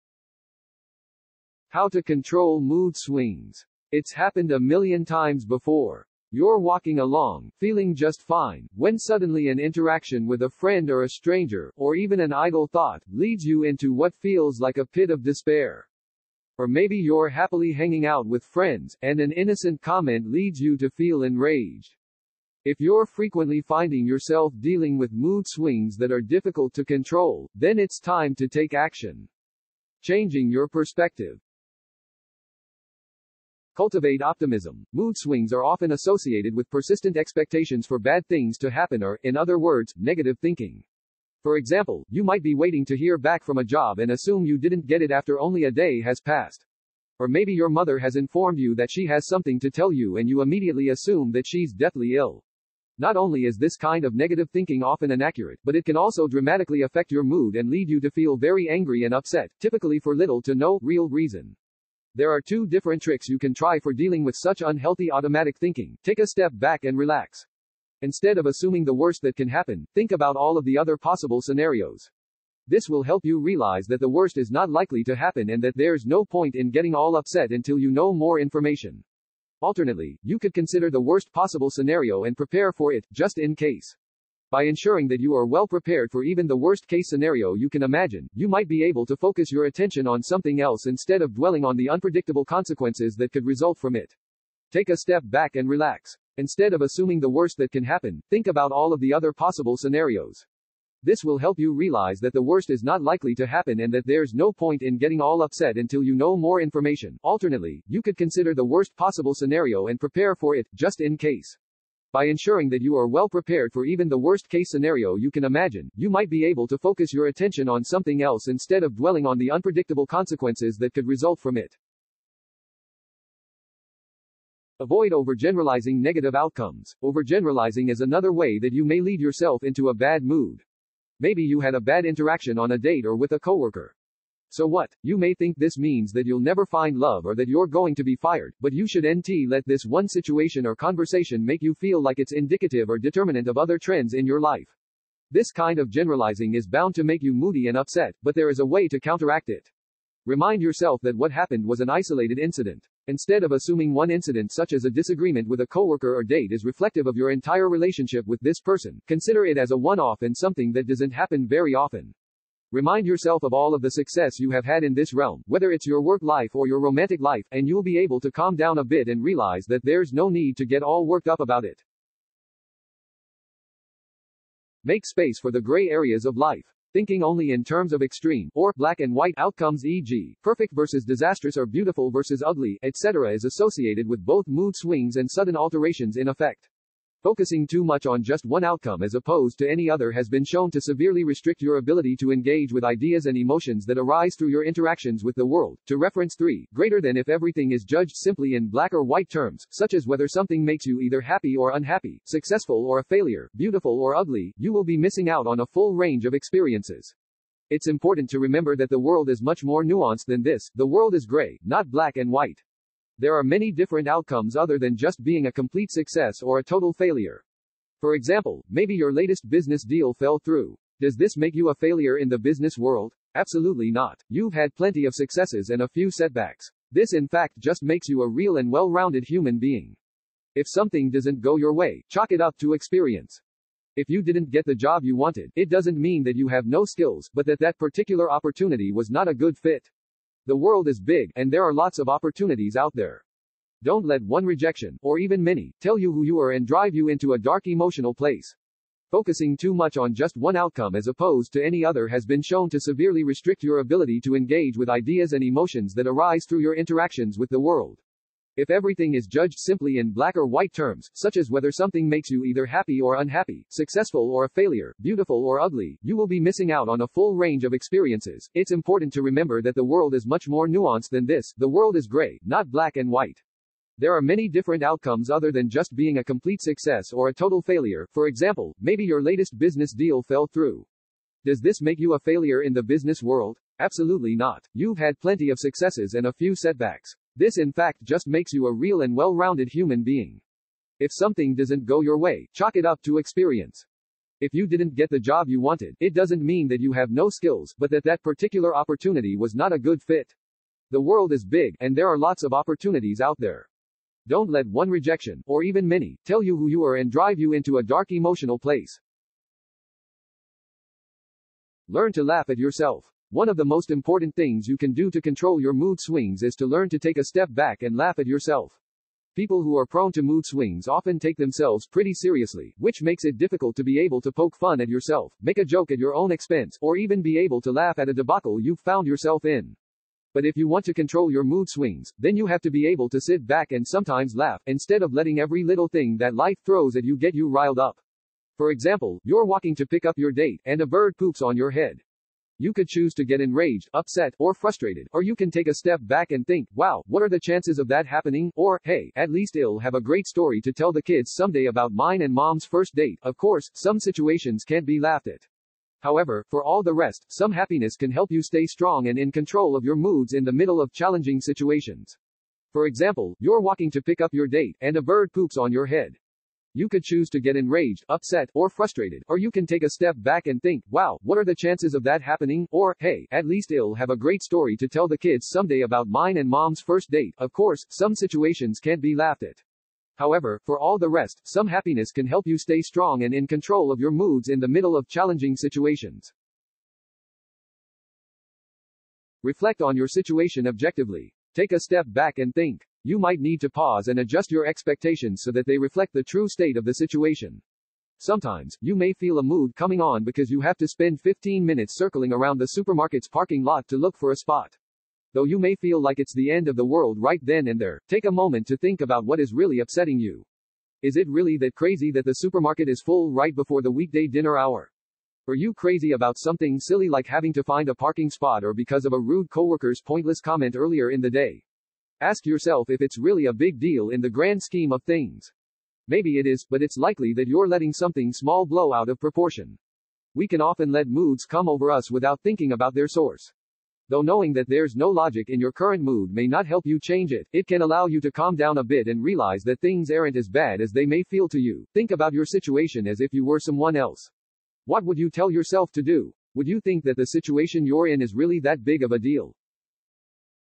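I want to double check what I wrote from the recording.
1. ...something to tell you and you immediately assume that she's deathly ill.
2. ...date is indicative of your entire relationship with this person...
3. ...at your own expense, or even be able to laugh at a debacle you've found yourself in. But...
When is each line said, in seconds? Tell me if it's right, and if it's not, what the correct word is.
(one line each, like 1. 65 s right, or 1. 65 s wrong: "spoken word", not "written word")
1. 49 s right
2. 156 s wrong: "reflective", not "indicative"
3. 325 s right.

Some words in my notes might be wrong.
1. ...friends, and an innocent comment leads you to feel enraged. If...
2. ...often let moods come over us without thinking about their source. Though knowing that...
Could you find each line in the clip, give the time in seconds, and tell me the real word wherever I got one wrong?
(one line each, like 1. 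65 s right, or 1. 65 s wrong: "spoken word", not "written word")
1. 18 s right
2. 430 s right.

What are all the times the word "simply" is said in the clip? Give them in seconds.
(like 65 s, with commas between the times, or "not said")
198 s, 259 s.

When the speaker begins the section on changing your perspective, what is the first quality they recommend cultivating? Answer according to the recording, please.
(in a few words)
optimism.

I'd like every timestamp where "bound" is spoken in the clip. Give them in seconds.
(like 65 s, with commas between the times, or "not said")
146 s.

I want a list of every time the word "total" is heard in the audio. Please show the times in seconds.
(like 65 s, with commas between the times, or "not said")
216 s, 277 s.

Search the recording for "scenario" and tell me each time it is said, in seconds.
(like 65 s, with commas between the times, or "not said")
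71 s, 81 s, 87 s, 99 s, 109 s, 114 s.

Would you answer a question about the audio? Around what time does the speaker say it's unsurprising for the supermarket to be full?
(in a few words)
weekday dinner hour.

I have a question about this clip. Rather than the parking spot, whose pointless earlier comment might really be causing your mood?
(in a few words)
a rude coworker.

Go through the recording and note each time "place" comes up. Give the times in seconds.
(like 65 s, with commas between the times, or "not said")
248 s, 308 s.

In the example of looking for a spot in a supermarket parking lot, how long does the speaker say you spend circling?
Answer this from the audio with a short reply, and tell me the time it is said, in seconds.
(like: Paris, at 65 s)
15 minutes, at 401 s.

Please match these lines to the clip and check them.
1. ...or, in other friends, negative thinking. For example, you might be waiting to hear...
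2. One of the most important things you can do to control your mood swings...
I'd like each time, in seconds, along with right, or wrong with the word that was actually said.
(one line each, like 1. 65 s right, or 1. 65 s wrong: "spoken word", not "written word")
1. 39 s wrong: "words", not "friends"
2. 313 s right.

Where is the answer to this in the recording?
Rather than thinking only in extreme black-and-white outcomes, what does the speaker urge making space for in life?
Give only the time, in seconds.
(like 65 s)
175 s.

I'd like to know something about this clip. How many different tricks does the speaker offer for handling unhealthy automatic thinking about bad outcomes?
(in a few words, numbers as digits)
2.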